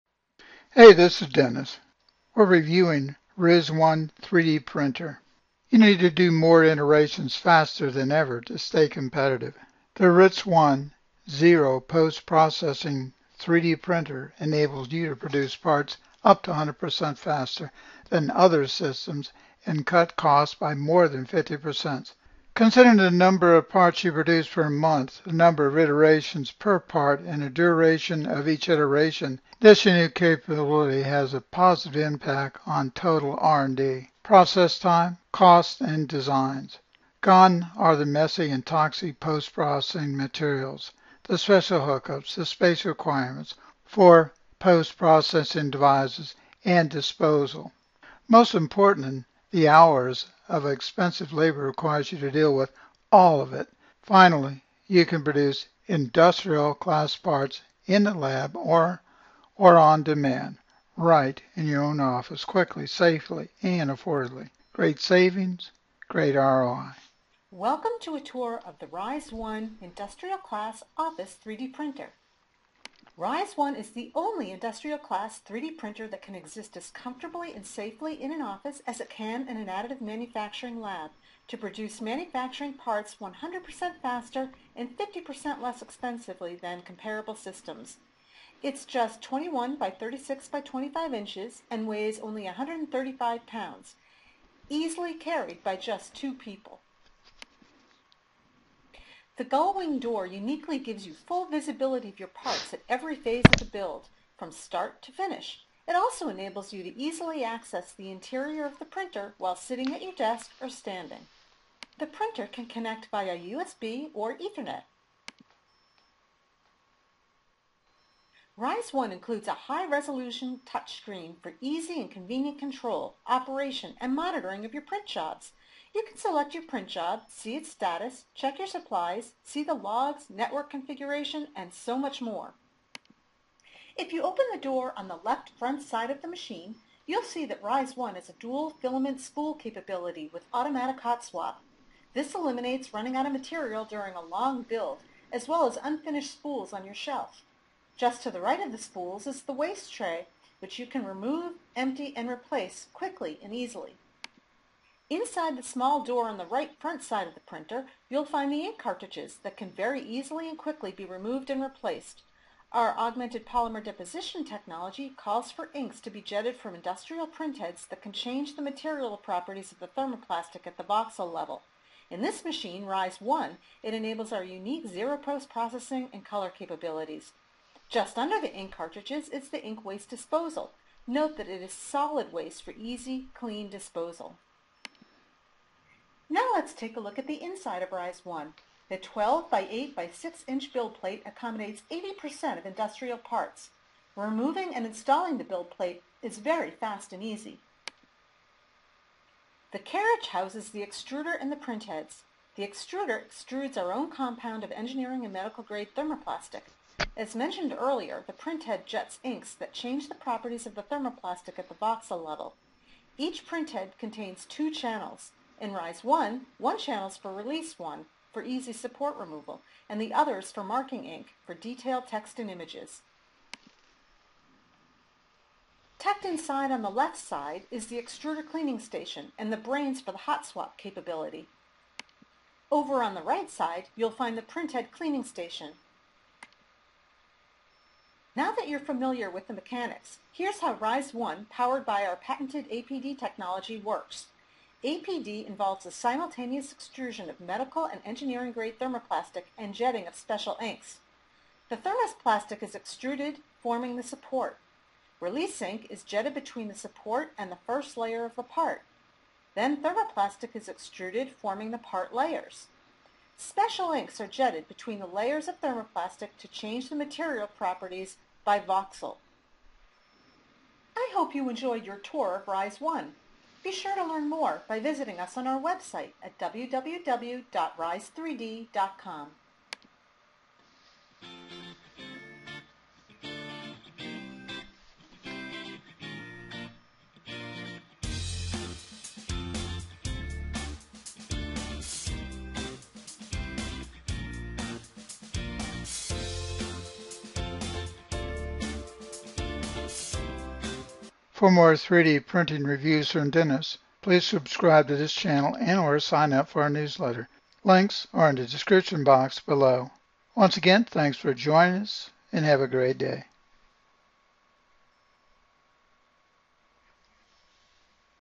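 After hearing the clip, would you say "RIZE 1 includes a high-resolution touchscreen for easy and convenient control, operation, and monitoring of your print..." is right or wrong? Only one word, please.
right.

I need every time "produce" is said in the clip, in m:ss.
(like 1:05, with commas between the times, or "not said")
0:15, 0:24, 0:55, 1:21.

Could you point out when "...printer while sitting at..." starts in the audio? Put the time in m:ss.
1:48.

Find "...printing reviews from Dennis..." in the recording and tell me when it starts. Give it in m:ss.
5:02.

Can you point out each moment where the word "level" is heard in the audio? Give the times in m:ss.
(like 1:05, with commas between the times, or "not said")
2:51, 3:32.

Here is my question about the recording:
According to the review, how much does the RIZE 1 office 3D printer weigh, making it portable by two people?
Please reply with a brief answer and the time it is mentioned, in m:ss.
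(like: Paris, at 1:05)
135 pounds, at 1:32.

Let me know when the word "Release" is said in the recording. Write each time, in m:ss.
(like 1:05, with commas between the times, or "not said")
3:37, 4:15.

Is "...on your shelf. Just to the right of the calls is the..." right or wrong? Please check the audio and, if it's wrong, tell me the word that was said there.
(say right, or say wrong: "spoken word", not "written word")
wrong: "spools", not "calls".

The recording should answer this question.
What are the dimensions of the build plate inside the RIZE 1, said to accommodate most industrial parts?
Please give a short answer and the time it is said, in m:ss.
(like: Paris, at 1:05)
12 by 8 by 6 inches, at 3:08.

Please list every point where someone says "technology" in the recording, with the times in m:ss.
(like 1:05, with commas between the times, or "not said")
2:44, 4:03.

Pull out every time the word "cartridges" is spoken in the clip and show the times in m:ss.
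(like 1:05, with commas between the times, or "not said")
2:38, 2:58.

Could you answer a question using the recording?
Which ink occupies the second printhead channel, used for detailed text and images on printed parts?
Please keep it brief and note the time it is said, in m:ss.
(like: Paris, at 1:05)
Marking Ink, at 3:40.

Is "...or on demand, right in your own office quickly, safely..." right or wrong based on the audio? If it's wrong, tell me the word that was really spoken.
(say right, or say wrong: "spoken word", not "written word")
right.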